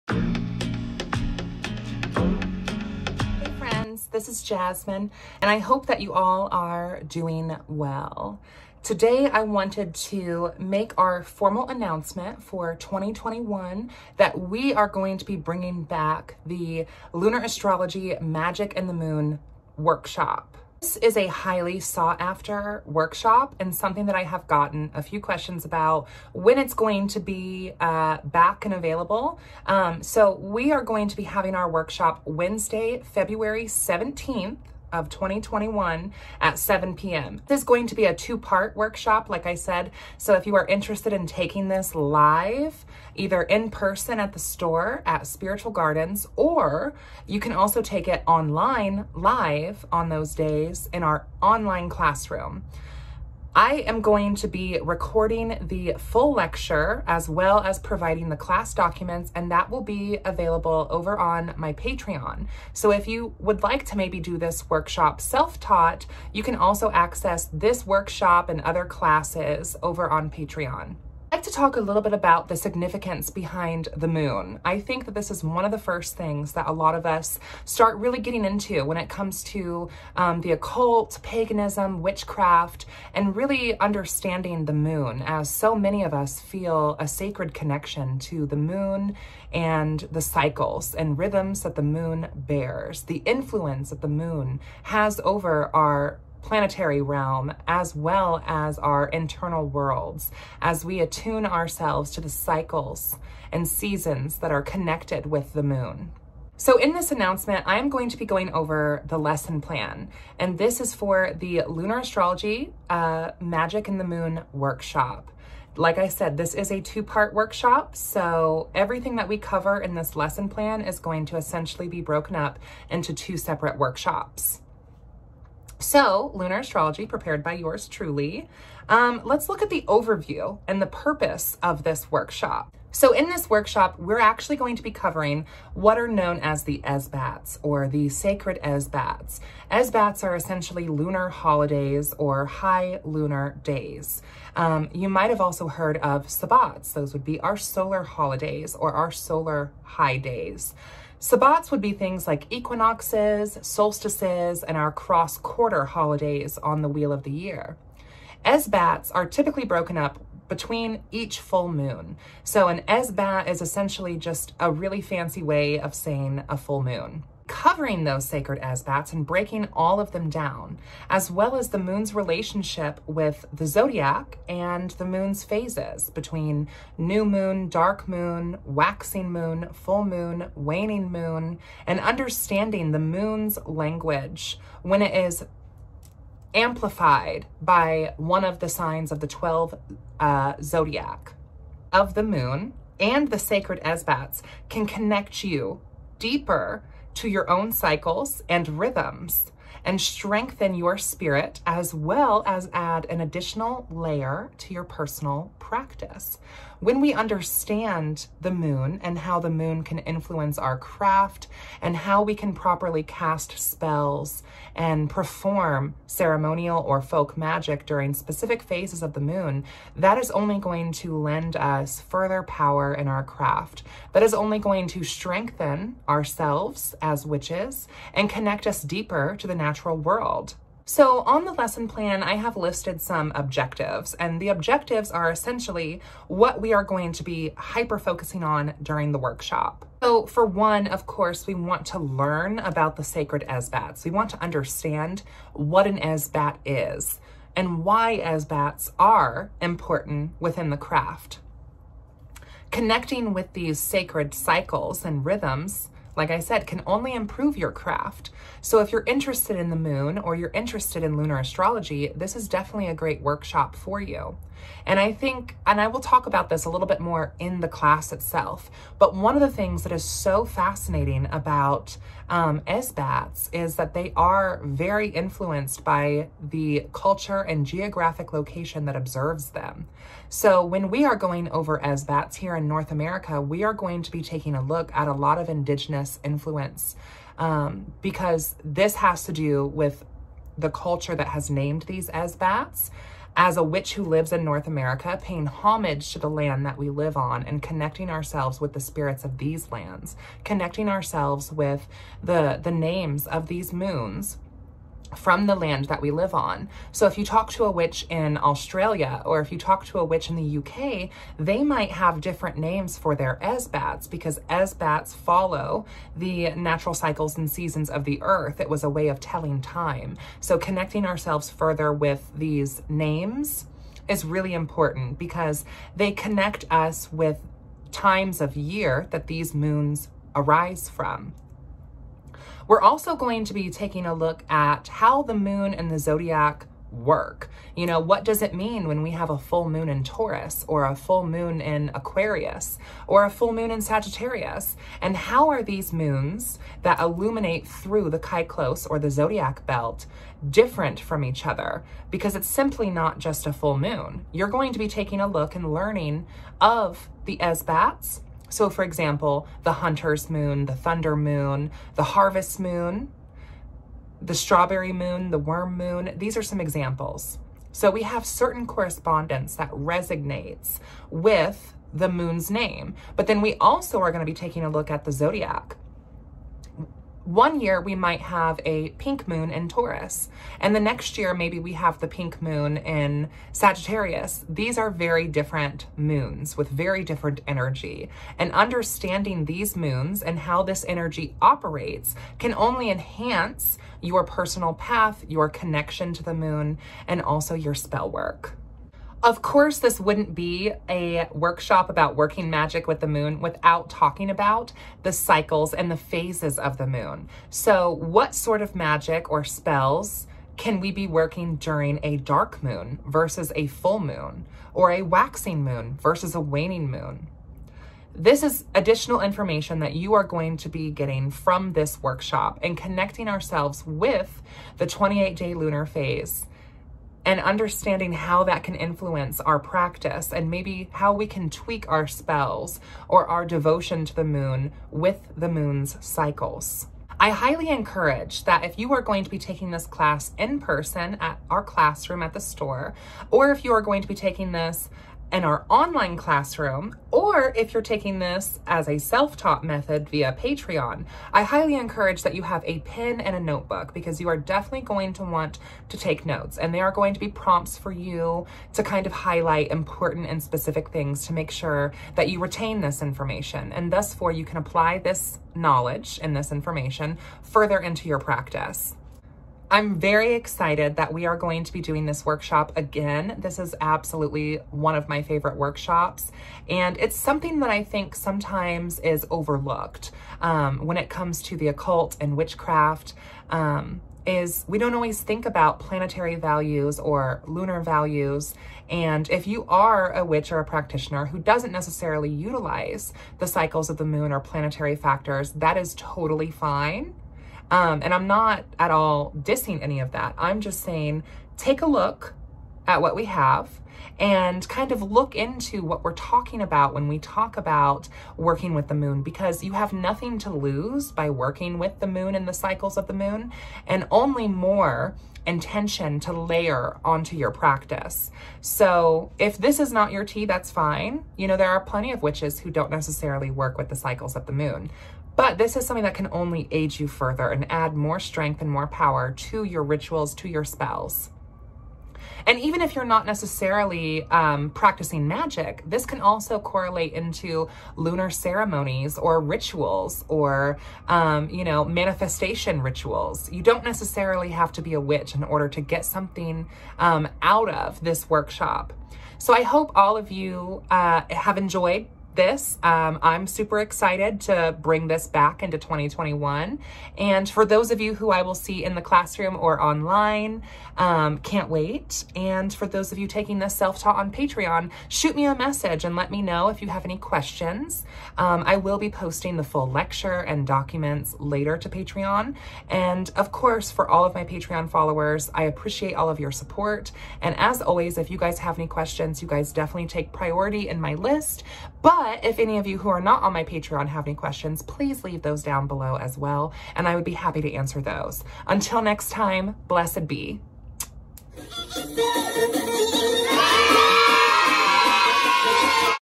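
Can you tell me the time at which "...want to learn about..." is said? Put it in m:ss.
4:01.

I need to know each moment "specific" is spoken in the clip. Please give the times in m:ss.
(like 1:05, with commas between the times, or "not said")
3:38, 7:40.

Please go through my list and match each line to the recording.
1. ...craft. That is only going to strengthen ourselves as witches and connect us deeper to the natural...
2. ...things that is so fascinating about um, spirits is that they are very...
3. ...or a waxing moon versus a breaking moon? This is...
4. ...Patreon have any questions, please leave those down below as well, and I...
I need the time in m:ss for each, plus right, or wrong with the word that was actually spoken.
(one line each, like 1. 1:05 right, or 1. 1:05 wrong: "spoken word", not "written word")
1. 3:43 right
2. 4:29 wrong: "esbats", not "spirits"
3. 6:54 wrong: "waning", not "breaking"
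4. 9:43 right.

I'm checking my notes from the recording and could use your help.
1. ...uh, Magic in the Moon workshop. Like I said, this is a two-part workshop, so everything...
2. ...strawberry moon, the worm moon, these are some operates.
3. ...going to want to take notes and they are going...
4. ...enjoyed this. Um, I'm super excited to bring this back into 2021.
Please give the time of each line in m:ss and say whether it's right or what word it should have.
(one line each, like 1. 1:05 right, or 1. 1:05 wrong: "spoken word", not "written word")
1. 1:52 right
2. 6:04 wrong: "examples", not "operates"
3. 7:34 right
4. 9:11 right.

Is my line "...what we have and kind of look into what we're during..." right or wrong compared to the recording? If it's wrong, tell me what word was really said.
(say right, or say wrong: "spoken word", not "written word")
wrong: "talking", not "during".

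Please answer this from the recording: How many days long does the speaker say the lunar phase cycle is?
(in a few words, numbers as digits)
28.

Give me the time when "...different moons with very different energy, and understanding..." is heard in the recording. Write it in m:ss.
6:25.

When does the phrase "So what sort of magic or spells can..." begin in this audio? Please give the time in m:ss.
6:47.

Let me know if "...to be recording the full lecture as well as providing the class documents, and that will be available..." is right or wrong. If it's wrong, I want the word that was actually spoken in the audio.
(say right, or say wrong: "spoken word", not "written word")
right.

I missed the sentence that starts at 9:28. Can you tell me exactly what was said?
Um, I will be posting the full lecture and documents later to Patreon.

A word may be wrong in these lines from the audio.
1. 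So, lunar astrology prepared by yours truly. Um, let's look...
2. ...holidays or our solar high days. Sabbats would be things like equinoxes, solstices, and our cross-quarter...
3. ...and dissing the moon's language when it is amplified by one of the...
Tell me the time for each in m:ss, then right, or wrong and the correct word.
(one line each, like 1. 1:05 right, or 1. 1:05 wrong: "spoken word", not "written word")
1. 2:05 right
2. 2:28 right
3. 3:01 wrong: "understanding", not "dissing".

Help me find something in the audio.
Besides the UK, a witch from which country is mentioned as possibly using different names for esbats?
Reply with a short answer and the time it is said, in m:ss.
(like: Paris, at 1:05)
Australia, at 5:08.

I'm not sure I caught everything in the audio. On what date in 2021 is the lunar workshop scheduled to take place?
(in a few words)
February 17.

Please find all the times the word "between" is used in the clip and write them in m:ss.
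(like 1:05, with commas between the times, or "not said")
2:40, 2:56.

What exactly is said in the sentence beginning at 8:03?
Um, is we don't always think about planetary values or lunar values.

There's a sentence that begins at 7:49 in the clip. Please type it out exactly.
I'm very excited that we are going to be doing this workshop again.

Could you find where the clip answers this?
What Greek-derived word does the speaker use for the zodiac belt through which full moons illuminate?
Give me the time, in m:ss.
5:48.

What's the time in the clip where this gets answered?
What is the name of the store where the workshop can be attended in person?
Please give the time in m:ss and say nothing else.
0:45.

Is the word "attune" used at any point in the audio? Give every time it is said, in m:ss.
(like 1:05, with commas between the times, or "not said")
1:40.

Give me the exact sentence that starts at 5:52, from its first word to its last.
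Because it's simply not just a full moon.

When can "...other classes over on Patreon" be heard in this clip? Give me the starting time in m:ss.
1:08.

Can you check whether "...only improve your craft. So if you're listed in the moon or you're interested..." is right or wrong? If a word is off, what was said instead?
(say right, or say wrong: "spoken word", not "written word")
wrong: "interested", not "listed".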